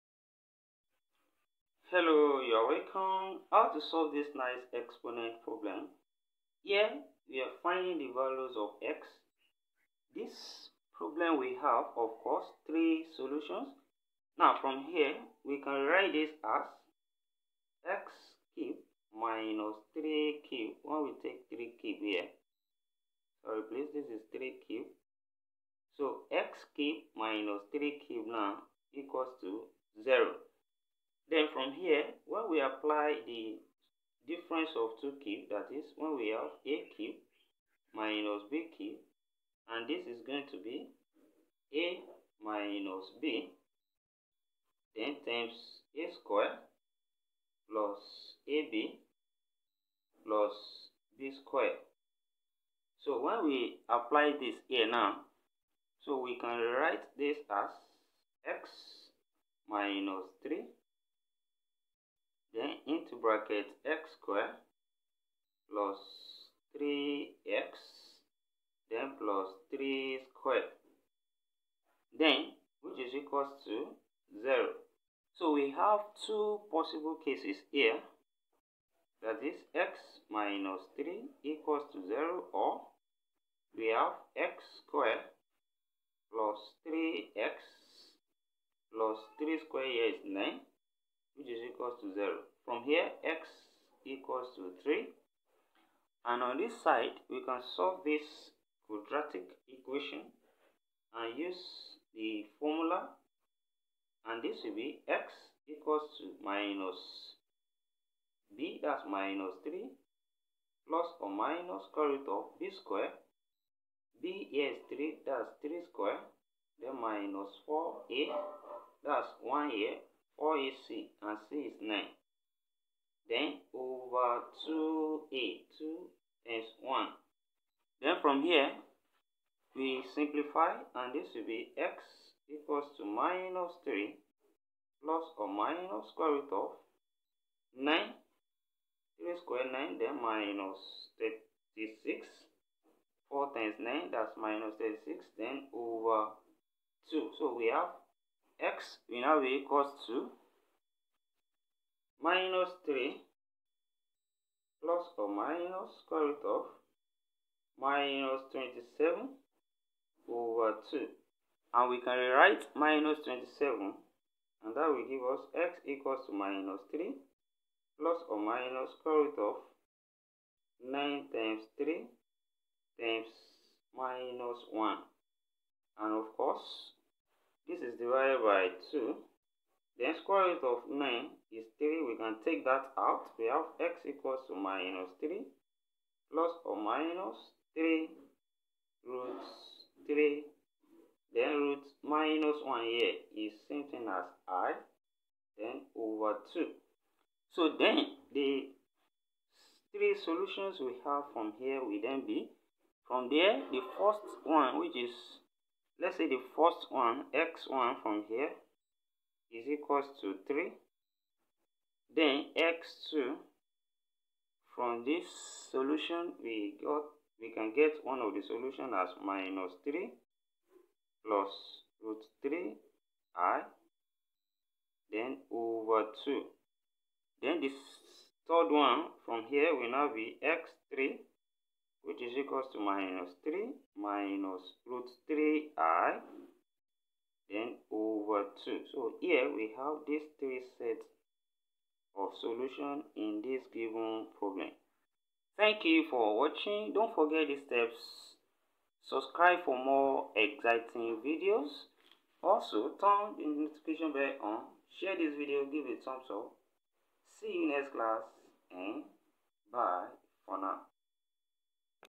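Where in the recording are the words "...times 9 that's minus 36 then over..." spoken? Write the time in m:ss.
2:23.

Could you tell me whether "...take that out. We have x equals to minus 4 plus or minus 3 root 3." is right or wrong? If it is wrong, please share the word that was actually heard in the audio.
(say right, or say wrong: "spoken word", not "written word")
wrong: "3", not "4".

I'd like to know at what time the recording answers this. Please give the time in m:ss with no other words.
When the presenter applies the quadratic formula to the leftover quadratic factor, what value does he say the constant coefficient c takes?
2:01.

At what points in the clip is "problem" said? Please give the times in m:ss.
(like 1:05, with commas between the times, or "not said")
0:05, 0:10, 4:04.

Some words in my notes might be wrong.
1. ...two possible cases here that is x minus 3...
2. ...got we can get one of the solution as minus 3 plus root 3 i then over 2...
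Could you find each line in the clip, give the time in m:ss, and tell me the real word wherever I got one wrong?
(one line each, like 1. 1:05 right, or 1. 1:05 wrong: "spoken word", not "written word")
1. 1:16 right
2. 3:36 right.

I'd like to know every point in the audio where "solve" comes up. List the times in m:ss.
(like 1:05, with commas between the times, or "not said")
0:03, 1:37.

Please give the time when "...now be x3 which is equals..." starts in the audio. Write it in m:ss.
3:49.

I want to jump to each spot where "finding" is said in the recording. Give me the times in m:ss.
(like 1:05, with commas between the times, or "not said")
0:07.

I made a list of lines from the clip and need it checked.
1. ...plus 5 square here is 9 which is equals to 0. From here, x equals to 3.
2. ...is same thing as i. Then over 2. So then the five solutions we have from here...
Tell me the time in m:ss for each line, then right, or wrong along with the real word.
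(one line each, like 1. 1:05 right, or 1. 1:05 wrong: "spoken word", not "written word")
1. 1:28 wrong: "3", not "5"
2. 3:13 wrong: "three", not "five".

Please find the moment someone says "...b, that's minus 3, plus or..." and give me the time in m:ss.
1:48.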